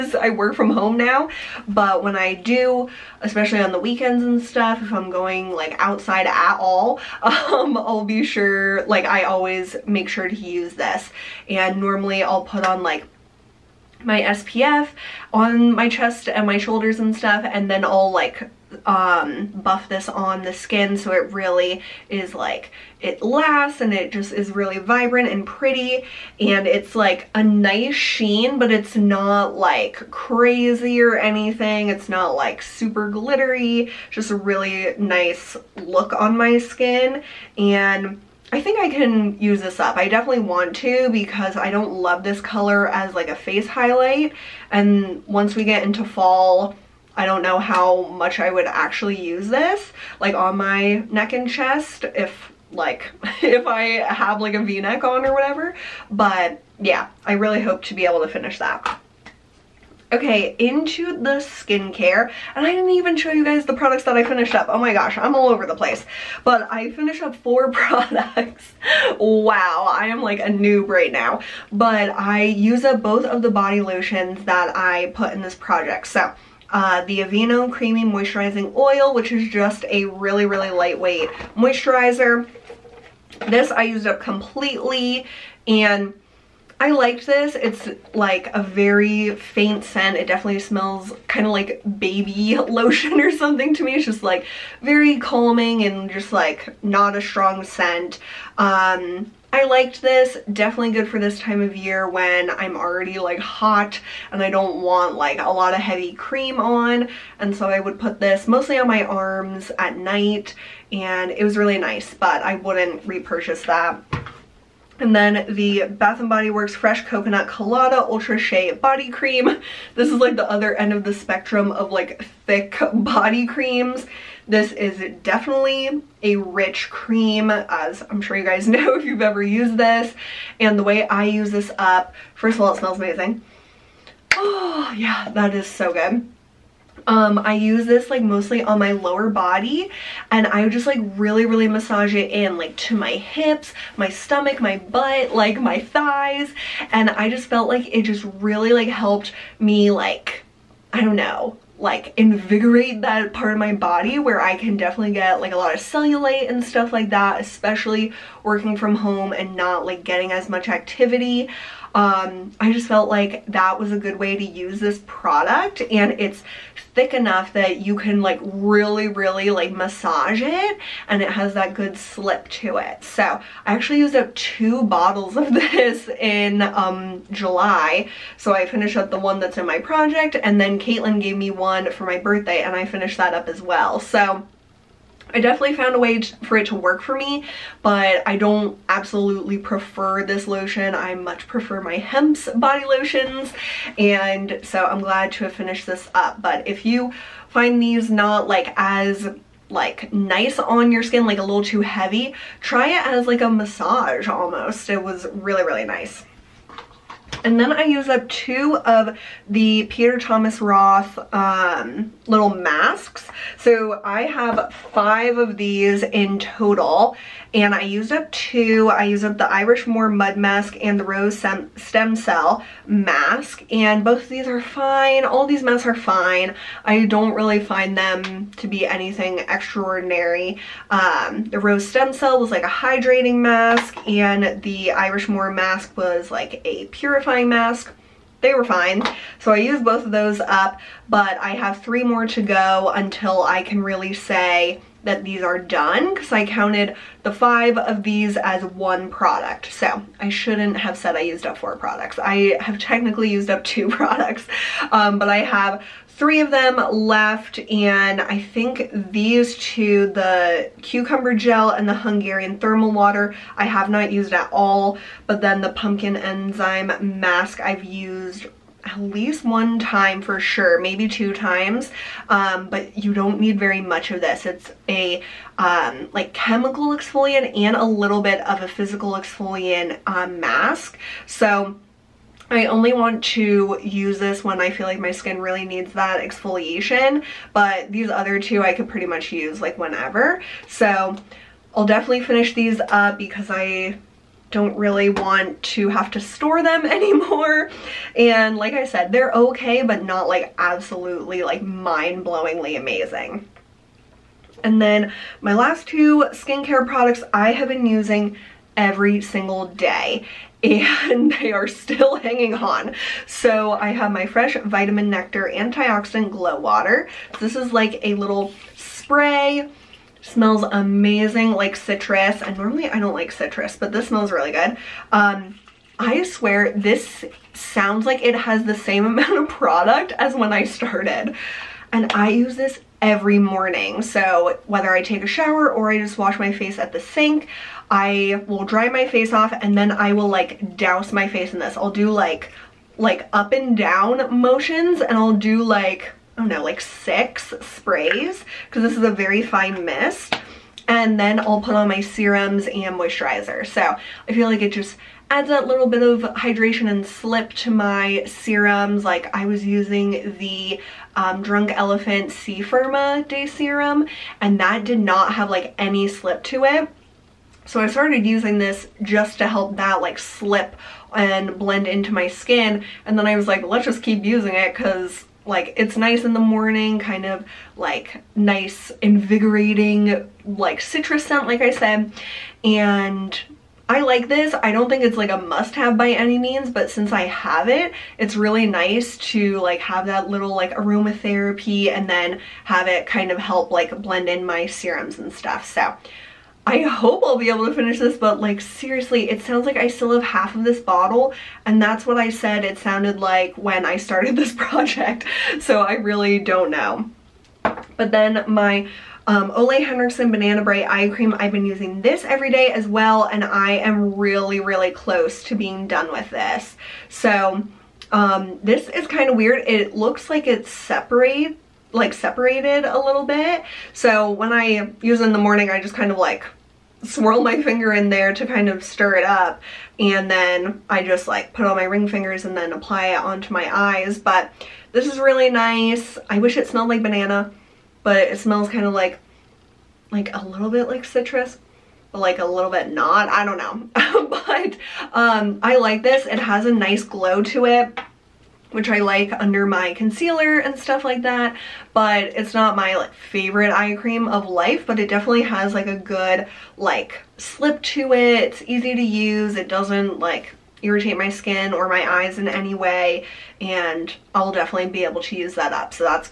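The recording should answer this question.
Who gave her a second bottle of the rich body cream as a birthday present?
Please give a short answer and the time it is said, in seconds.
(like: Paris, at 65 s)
Caitlin, at 180 s.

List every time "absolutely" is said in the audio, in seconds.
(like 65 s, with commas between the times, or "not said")
188 s, 300 s.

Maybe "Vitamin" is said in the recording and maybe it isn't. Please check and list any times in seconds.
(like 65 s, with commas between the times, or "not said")
314 s.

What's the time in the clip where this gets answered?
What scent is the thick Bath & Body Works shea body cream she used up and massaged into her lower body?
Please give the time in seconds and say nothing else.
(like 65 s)
116 s.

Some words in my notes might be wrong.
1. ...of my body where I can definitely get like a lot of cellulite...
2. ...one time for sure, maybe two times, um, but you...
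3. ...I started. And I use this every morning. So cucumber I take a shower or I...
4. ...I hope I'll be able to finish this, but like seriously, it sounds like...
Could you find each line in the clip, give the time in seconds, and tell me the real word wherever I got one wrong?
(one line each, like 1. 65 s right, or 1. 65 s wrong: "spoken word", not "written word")
1. 153 s right
2. 269 s right
3. 330 s wrong: "whether", not "cucumber"
4. 396 s right.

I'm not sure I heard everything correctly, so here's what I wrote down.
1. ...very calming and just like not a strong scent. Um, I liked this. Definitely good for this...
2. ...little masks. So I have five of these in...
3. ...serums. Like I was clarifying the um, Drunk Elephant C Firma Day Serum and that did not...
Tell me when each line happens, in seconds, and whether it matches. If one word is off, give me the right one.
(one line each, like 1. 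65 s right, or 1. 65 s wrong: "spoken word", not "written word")
1. 94 s right
2. 212 s right
3. 358 s wrong: "using", not "clarifying".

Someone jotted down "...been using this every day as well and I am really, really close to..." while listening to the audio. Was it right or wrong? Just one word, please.
right.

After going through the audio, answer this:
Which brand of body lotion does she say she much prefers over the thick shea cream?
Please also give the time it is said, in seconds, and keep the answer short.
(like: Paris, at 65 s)
Hempz, at 191 s.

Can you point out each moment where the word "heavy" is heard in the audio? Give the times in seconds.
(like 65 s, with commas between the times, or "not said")
105 s, 201 s.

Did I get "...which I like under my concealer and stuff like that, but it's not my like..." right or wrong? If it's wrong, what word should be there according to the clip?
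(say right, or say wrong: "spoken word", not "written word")
right.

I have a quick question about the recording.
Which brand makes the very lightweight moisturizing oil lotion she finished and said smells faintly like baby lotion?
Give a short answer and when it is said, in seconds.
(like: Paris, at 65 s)
Aveeno, at 77 s.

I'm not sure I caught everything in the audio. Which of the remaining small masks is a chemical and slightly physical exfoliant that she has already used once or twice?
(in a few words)
pumpkin enzyme mask.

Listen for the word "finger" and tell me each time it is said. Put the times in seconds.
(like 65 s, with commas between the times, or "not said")
427 s, 432 s.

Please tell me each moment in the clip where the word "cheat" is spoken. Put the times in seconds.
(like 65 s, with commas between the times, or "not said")
not said.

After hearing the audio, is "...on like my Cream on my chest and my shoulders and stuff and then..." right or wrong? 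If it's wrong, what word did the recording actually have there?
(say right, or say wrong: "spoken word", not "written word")
wrong: "SPF", not "Cream".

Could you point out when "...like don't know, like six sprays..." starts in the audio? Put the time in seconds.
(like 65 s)
345 s.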